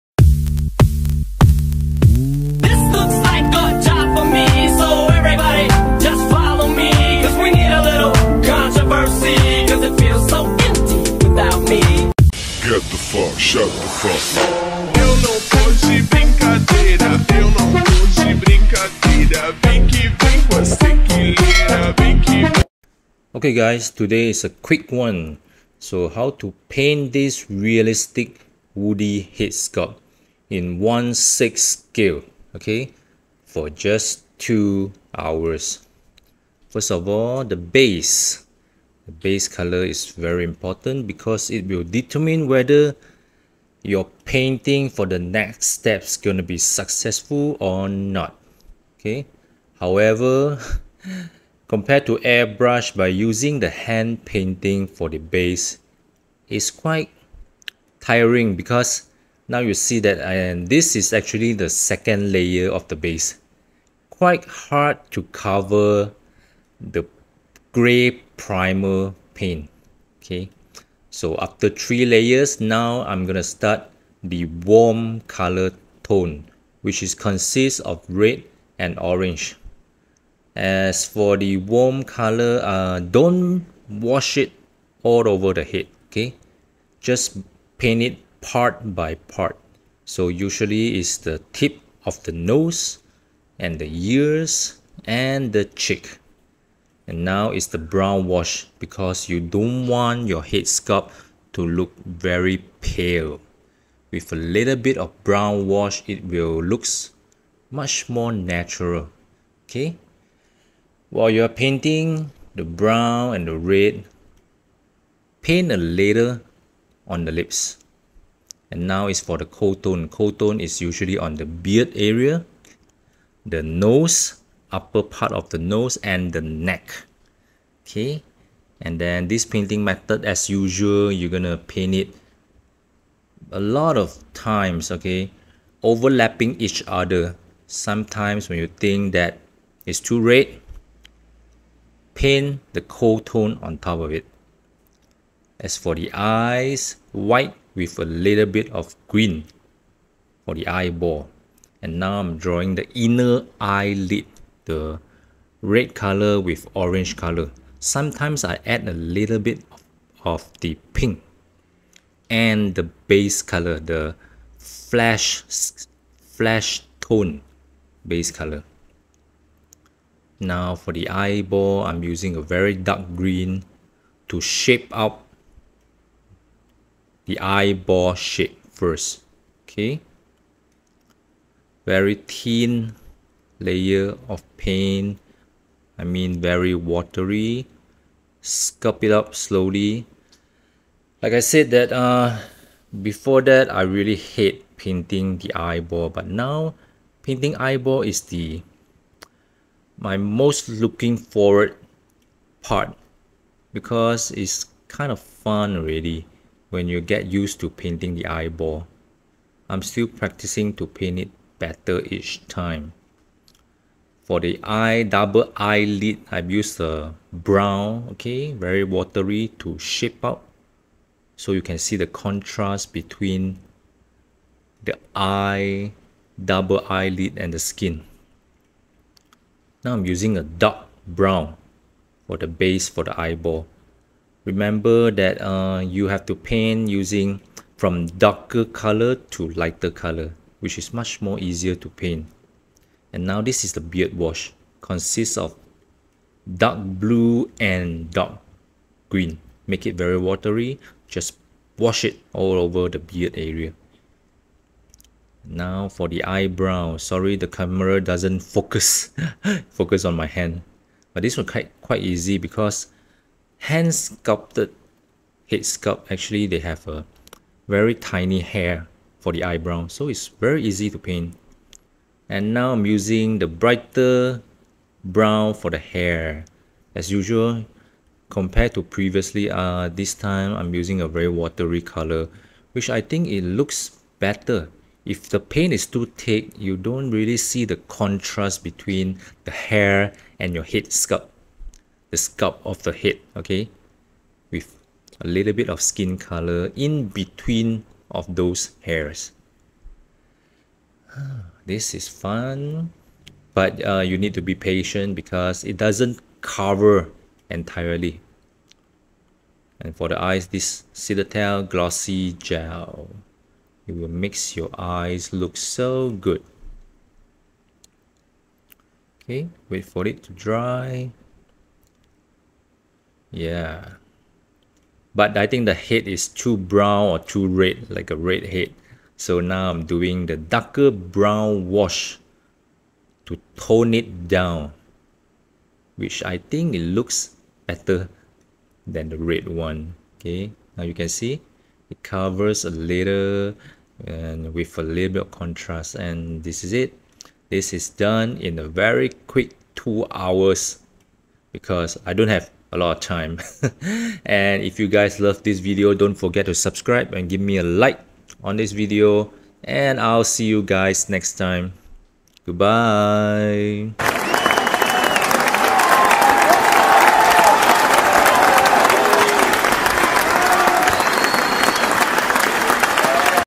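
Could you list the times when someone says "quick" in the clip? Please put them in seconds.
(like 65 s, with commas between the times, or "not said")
24 s, 349 s.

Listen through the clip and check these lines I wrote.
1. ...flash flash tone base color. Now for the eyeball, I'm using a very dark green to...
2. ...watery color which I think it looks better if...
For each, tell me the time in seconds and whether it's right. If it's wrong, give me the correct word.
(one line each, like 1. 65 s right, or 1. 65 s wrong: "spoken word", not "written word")
1. 164 s right
2. 281 s right.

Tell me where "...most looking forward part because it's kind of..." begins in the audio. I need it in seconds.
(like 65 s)
200 s.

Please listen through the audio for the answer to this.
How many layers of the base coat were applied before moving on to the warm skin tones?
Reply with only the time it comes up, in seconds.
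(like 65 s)
71 s.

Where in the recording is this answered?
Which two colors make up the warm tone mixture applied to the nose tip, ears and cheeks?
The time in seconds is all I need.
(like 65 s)
78 s.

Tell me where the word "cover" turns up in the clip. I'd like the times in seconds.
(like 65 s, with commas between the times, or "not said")
65 s, 306 s, 342 s.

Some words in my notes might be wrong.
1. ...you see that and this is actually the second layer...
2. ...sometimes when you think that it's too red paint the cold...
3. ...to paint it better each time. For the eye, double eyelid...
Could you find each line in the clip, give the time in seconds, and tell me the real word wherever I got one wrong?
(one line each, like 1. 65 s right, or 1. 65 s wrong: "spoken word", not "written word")
1. 59 s right
2. 137 s right
3. 210 s right.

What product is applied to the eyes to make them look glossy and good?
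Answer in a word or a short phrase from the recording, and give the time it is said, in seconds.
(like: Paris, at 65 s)
Citadel Glossy Gel, at 310 s.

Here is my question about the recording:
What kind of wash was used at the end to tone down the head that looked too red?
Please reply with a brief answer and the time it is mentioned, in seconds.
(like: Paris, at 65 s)
darker brown wash, at 330 s.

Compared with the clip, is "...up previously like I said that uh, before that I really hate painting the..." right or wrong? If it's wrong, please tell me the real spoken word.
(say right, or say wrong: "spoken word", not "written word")
wrong: "slowly", not "previously".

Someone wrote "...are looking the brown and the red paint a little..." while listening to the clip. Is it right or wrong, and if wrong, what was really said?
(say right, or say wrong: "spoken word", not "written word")
wrong: "painting", not "looking".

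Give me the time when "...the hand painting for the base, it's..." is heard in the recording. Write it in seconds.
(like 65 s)
53 s.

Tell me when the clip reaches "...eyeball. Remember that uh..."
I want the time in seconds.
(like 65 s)
233 s.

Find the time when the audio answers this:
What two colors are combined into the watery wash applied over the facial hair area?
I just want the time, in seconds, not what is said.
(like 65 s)
246 s.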